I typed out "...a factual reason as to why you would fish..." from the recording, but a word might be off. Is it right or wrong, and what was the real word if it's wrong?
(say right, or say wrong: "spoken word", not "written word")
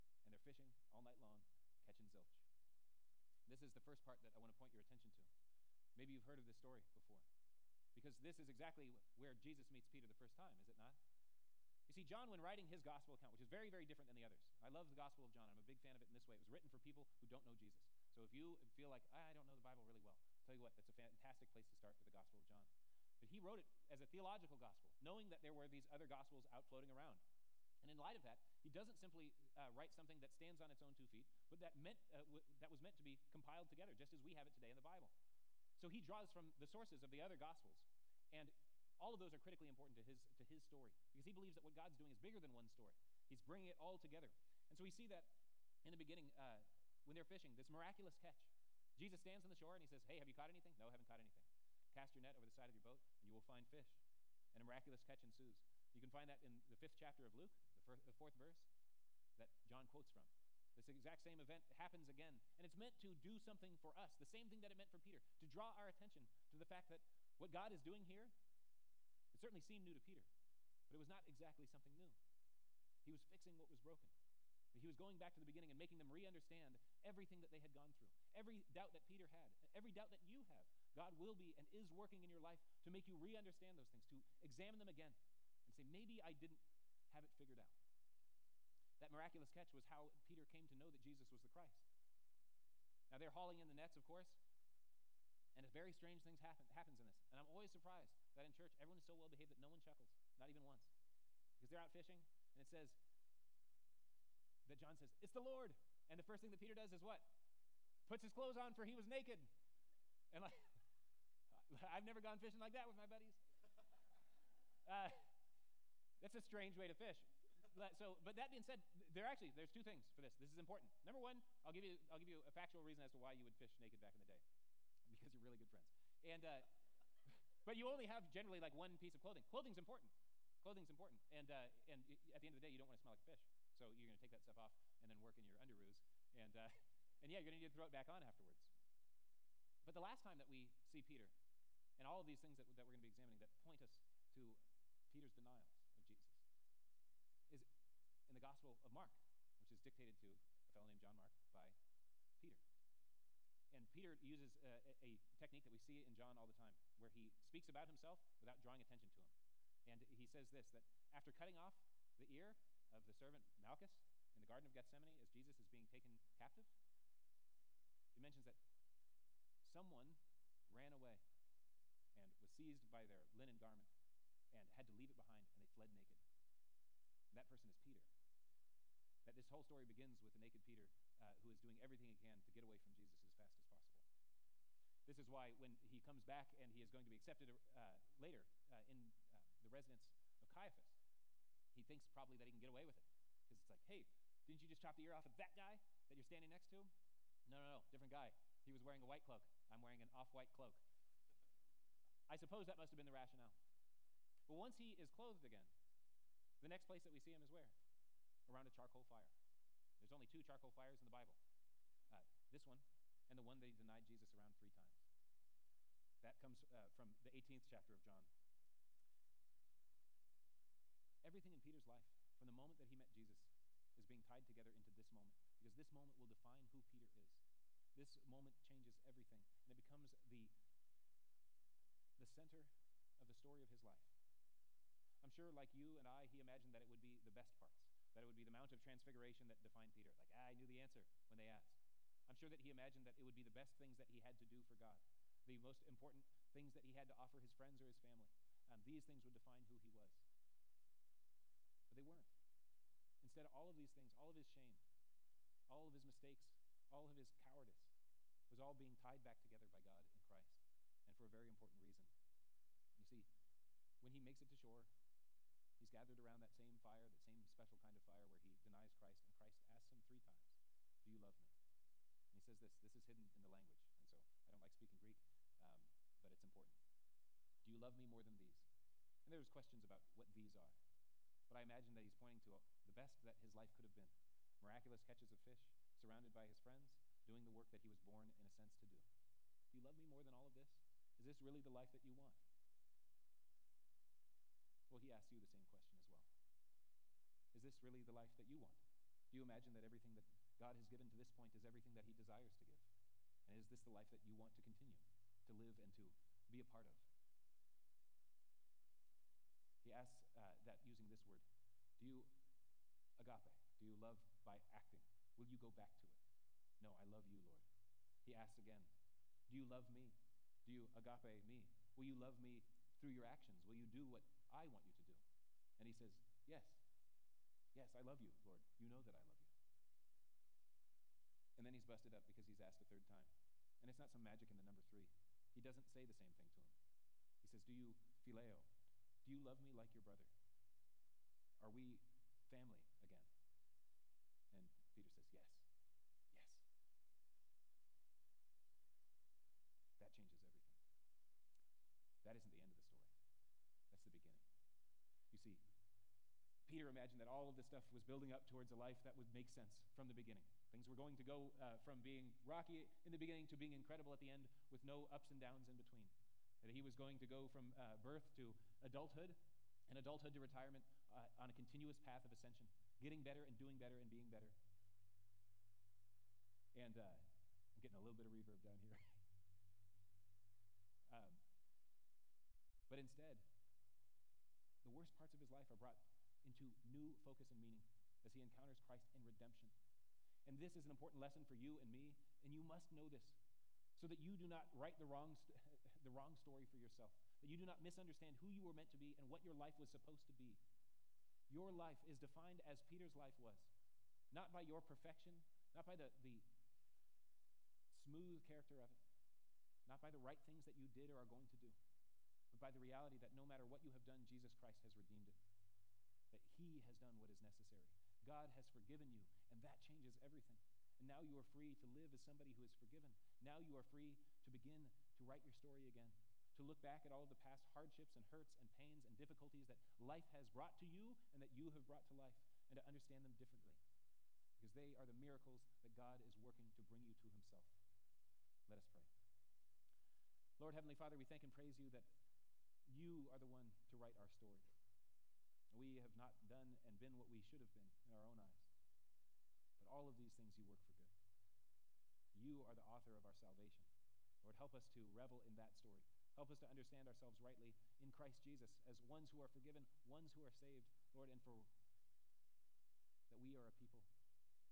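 right.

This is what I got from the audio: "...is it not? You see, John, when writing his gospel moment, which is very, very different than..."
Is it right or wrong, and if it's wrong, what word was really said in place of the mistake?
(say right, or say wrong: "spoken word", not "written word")
wrong: "account", not "moment".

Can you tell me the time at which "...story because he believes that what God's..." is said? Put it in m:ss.
0:40.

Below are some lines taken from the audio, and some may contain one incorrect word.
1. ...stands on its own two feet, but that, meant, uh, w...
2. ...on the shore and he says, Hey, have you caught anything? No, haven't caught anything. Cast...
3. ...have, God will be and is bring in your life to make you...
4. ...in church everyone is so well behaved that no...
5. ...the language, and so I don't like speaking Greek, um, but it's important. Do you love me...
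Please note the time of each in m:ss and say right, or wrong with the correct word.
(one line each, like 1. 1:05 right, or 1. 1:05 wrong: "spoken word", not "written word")
1. 0:30 right
2. 0:49 right
3. 1:20 wrong: "working", not "bring"
4. 1:38 right
5. 4:33 right.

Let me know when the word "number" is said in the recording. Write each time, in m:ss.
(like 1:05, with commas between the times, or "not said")
2:01, 5:34.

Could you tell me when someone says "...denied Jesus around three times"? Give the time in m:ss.
3:33.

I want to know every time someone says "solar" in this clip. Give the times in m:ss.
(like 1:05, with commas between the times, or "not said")
not said.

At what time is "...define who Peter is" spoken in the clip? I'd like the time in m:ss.
3:46.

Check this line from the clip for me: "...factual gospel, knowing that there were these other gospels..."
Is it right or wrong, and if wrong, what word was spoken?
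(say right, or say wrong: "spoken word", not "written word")
wrong: "theological", not "factual".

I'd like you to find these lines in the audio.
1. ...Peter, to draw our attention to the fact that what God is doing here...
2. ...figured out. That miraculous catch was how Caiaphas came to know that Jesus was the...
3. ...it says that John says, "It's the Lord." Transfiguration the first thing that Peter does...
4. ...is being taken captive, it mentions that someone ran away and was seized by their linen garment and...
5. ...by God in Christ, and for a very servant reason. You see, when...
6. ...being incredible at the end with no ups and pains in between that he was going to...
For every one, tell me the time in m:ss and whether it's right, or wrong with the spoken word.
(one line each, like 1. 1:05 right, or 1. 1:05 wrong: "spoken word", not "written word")
1. 1:04 right
2. 1:27 wrong: "Peter", not "Caiaphas"
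3. 1:42 wrong: "And", not "Transfiguration"
4. 2:45 right
5. 4:19 wrong: "important", not "servant"
6. 6:03 wrong: "downs", not "pains".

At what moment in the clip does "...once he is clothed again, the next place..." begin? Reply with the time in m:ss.
3:24.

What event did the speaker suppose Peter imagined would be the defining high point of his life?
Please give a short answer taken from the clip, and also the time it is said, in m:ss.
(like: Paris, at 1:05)
Mount of Transfiguration, at 3:58.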